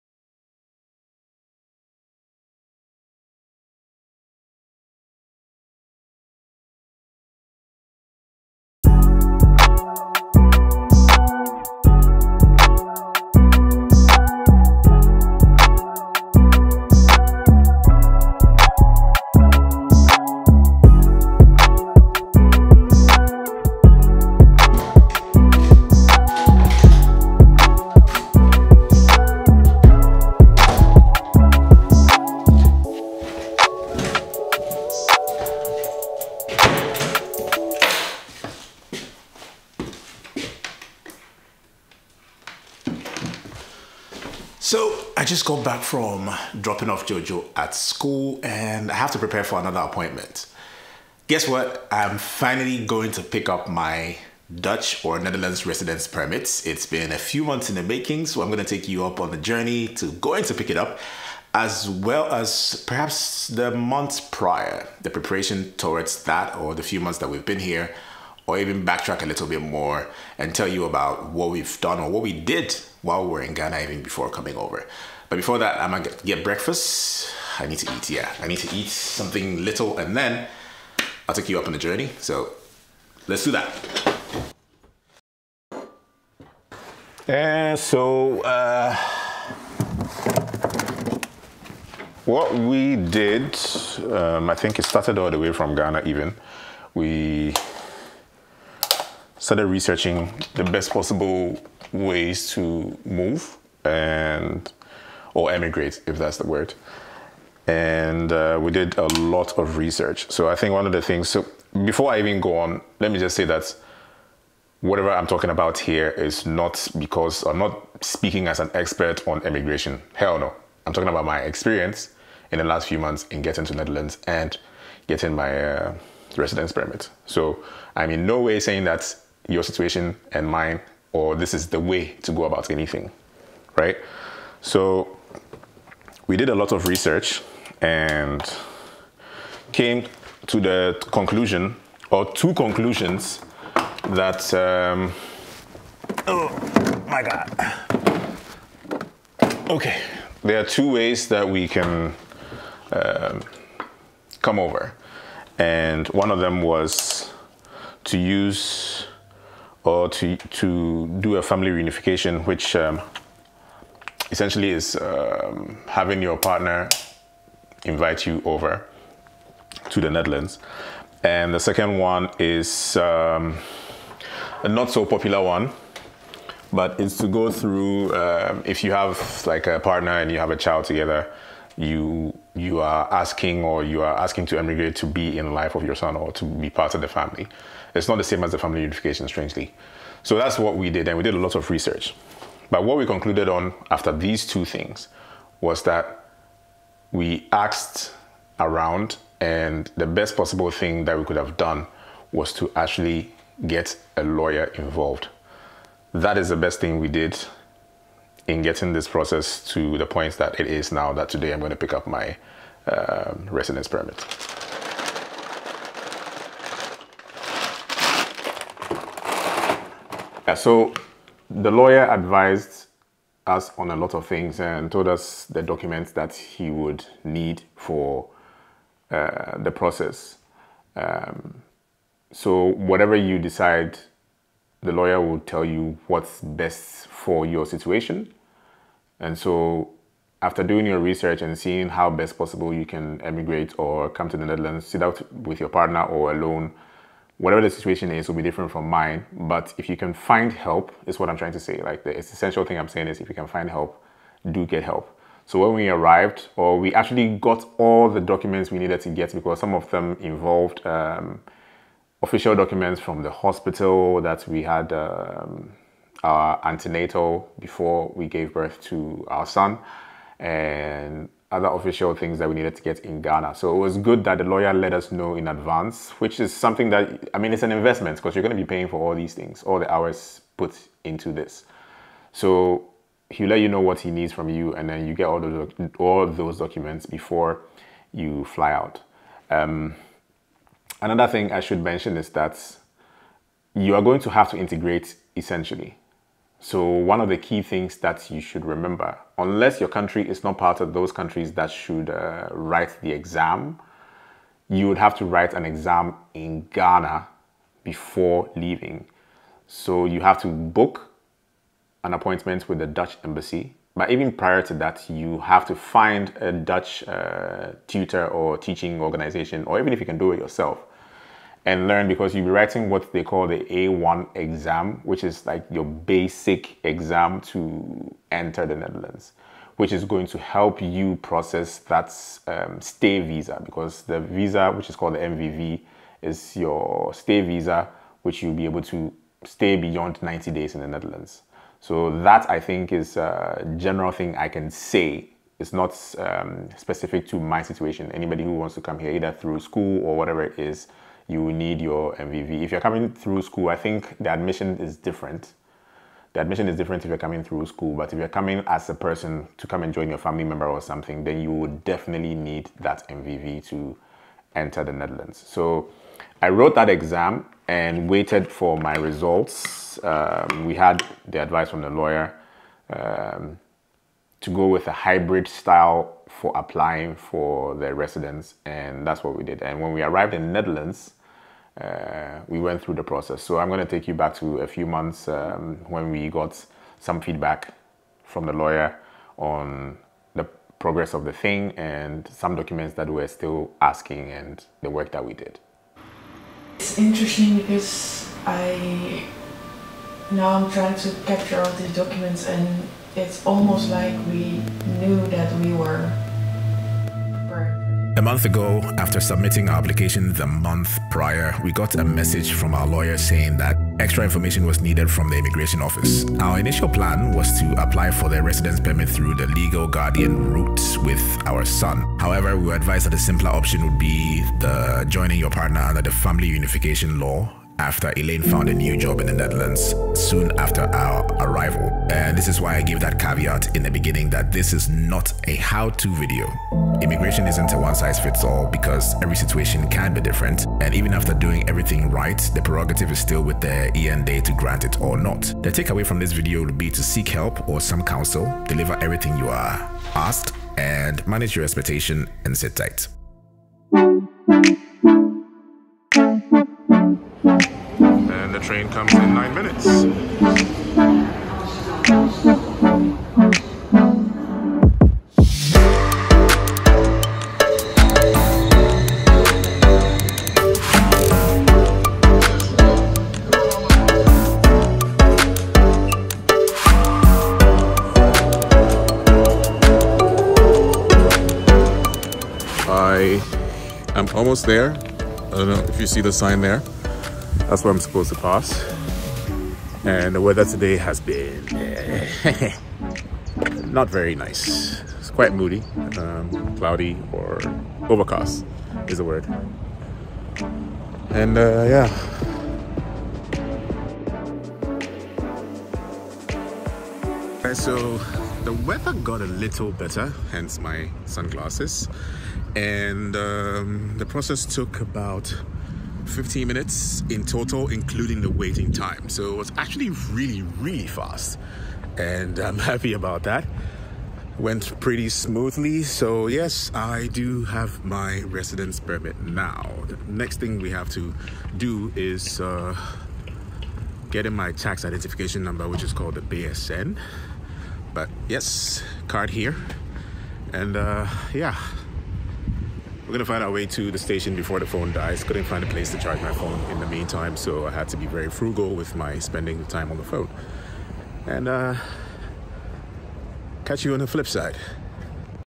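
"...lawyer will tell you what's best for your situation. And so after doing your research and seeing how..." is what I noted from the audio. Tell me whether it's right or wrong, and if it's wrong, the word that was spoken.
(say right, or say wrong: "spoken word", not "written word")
right.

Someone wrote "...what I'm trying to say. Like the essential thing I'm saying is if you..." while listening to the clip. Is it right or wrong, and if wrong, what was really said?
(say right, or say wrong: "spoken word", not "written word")
right.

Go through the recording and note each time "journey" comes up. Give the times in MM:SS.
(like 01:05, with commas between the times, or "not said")
00:59, 01:21.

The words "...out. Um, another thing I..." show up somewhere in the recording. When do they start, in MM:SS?
04:48.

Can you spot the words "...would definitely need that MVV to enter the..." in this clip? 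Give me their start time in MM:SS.
06:01.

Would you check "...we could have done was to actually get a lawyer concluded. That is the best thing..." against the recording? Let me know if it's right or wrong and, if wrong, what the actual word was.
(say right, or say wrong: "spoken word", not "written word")
wrong: "involved", not "concluded".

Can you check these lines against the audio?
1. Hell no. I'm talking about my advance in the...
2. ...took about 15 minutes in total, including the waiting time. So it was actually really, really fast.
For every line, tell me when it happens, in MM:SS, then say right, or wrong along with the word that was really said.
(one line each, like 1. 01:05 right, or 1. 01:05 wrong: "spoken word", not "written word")
1. 02:00 wrong: "experience", not "advance"
2. 08:34 right.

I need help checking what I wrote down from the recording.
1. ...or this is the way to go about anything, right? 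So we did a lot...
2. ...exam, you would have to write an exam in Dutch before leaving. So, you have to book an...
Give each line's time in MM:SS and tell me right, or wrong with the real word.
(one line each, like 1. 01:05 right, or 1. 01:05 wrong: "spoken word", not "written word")
1. 02:11 right
2. 05:03 wrong: "Ghana", not "Dutch".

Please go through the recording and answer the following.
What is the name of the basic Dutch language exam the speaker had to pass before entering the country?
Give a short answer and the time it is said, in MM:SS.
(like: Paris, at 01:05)
A1 exam, at 05:23.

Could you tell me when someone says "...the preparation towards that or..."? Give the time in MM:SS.
01:05.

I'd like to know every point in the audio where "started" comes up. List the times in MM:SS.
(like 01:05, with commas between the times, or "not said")
01:34, 01:39.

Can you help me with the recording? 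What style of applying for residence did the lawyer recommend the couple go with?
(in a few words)
hybrid.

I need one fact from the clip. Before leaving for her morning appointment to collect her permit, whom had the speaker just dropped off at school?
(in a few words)
Jojo.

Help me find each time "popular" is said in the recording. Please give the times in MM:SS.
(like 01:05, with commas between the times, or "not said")
02:55.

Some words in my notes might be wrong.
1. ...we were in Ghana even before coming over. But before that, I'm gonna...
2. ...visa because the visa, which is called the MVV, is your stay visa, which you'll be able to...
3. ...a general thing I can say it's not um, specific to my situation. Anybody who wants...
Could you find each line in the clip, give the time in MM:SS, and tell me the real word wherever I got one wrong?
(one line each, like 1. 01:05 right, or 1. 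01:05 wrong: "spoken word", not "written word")
1. 01:13 right
2. 05:33 right
3. 05:43 right.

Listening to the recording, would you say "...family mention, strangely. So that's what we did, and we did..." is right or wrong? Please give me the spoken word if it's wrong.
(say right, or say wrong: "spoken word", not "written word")
wrong: "unification", not "mention".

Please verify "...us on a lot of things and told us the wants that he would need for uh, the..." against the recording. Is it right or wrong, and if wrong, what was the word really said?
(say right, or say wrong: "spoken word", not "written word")
wrong: "documents", not "wants".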